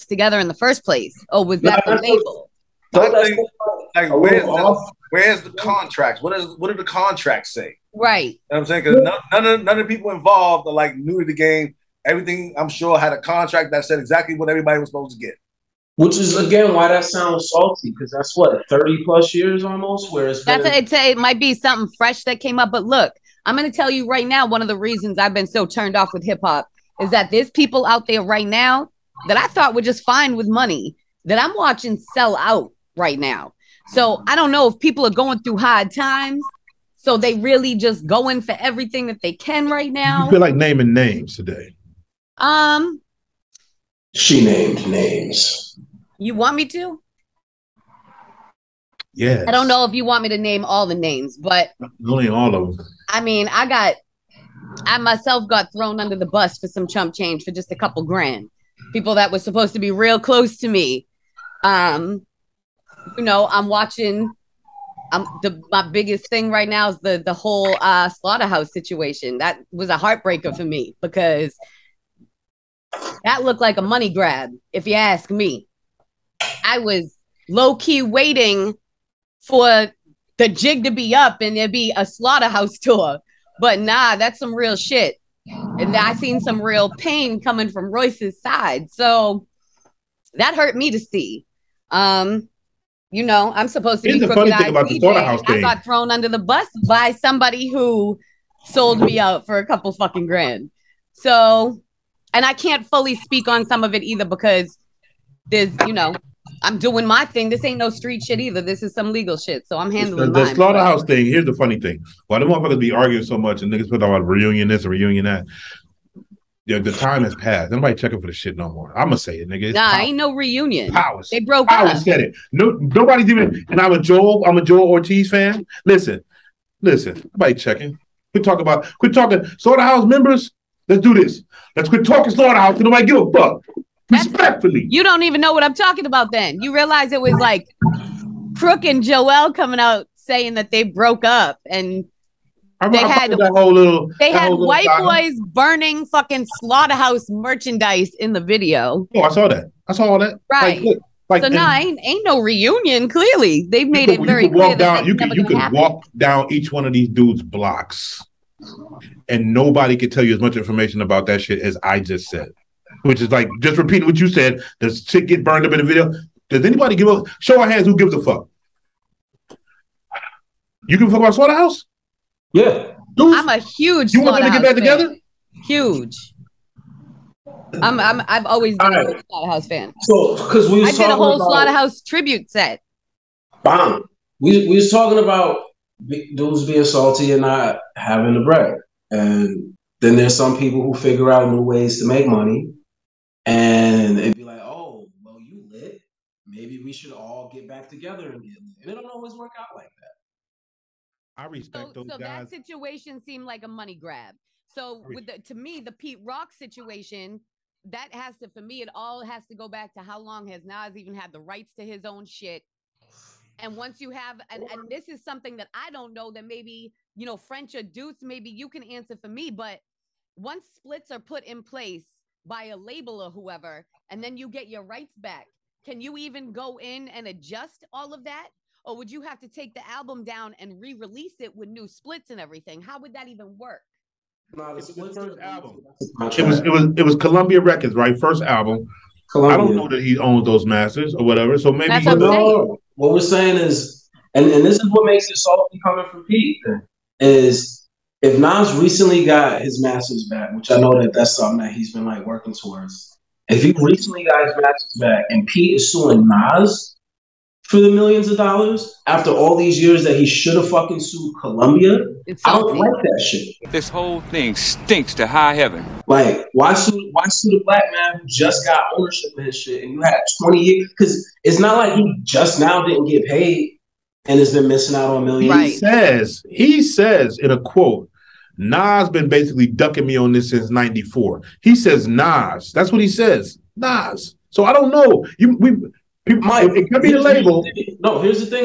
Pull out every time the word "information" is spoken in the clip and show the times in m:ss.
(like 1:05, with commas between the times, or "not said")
2:40.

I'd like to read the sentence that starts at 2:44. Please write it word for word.
Does shit get burned up in the video?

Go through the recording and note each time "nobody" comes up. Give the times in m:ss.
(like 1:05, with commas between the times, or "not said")
1:57, 2:02, 2:07, 2:12, 2:39.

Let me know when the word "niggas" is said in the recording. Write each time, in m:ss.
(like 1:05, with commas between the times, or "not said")
1:53, 1:59.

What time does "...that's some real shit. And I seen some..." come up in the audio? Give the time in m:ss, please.
1:24.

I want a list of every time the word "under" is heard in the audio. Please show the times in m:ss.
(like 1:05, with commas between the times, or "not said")
0:55, 1:36.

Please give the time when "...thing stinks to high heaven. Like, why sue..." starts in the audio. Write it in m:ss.
4:24.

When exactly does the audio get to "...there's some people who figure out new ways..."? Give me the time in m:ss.
3:10.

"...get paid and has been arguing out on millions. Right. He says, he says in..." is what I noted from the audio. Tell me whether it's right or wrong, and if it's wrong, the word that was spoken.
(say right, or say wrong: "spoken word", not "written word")
wrong: "missing", not "arguing".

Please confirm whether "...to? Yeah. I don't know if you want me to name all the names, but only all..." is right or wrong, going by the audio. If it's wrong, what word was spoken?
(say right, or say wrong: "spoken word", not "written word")
right.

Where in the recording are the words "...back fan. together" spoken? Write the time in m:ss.
2:54.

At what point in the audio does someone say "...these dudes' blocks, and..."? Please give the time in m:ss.
2:36.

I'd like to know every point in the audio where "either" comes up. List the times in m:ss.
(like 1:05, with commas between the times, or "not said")
1:44, 1:48.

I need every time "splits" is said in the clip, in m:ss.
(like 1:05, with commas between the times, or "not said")
3:40, 3:51.